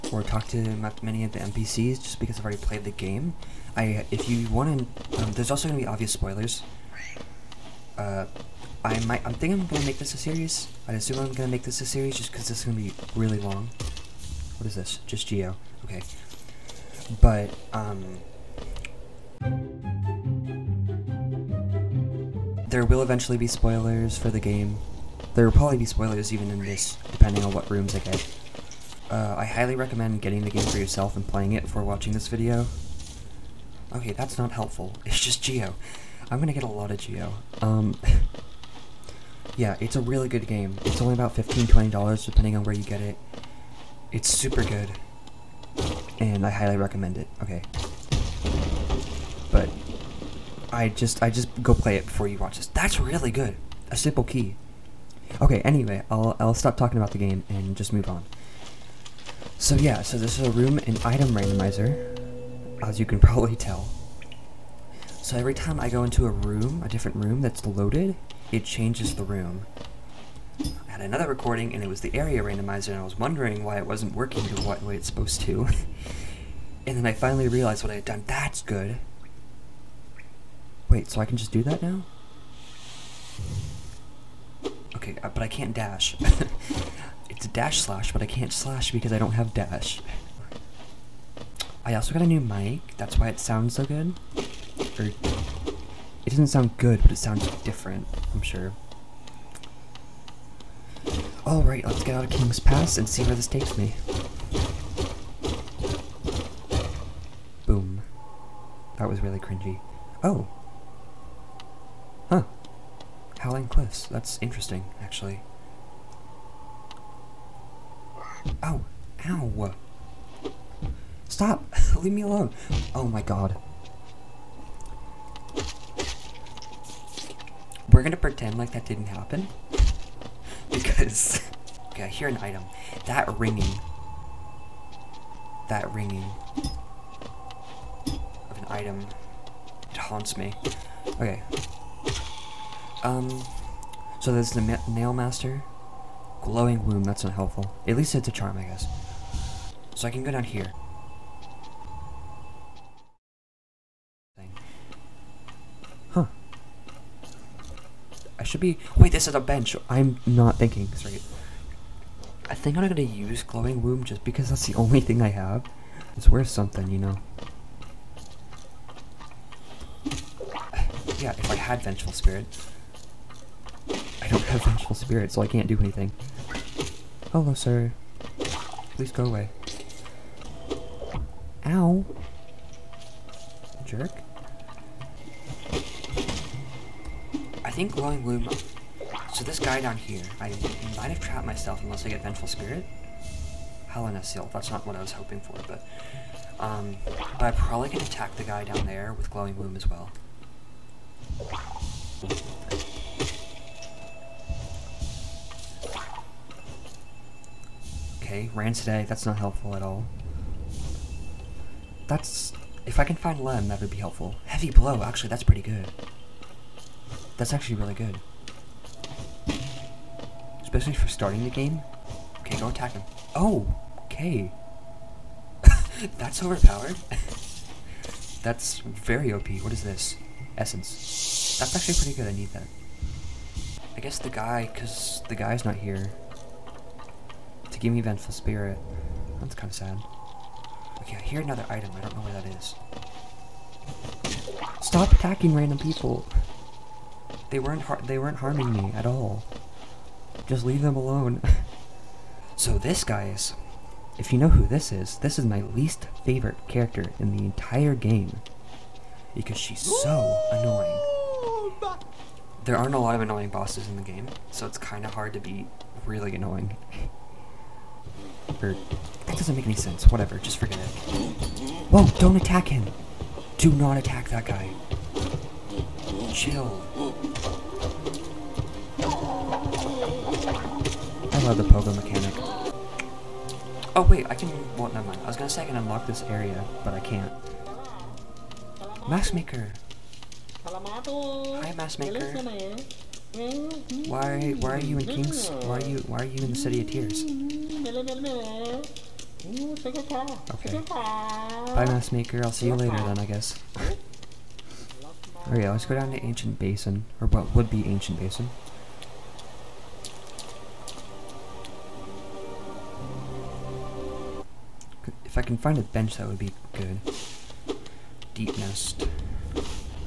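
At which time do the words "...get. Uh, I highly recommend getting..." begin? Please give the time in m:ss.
0:27.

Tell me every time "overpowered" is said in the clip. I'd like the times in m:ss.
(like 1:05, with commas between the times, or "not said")
3:46.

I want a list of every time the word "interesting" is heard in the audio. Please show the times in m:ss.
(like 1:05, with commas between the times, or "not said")
1:54.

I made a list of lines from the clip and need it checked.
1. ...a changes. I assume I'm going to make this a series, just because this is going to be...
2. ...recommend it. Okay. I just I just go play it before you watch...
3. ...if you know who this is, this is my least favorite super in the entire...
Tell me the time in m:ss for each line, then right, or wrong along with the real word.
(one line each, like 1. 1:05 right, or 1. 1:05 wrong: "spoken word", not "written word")
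1. 0:10 wrong: "series", not "changes"
2. 0:46 right
3. 4:14 wrong: "character", not "super".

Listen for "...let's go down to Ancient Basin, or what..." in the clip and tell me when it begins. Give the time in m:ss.
5:05.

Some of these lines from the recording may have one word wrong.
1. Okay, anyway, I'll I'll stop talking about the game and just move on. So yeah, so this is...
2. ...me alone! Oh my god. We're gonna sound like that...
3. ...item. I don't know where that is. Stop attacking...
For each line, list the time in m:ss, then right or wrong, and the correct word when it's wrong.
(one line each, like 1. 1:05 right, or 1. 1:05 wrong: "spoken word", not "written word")
1. 0:55 right
2. 2:02 wrong: "pretend", not "sound"
3. 4:01 right.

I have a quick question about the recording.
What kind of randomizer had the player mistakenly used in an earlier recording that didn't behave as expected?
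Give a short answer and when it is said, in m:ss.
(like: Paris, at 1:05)
Area randomizer, at 1:12.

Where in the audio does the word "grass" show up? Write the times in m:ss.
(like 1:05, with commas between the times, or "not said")
not said.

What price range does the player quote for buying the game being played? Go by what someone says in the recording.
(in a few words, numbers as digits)
$15 to $20.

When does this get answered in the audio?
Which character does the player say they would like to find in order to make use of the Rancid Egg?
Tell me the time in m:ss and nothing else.
3:33.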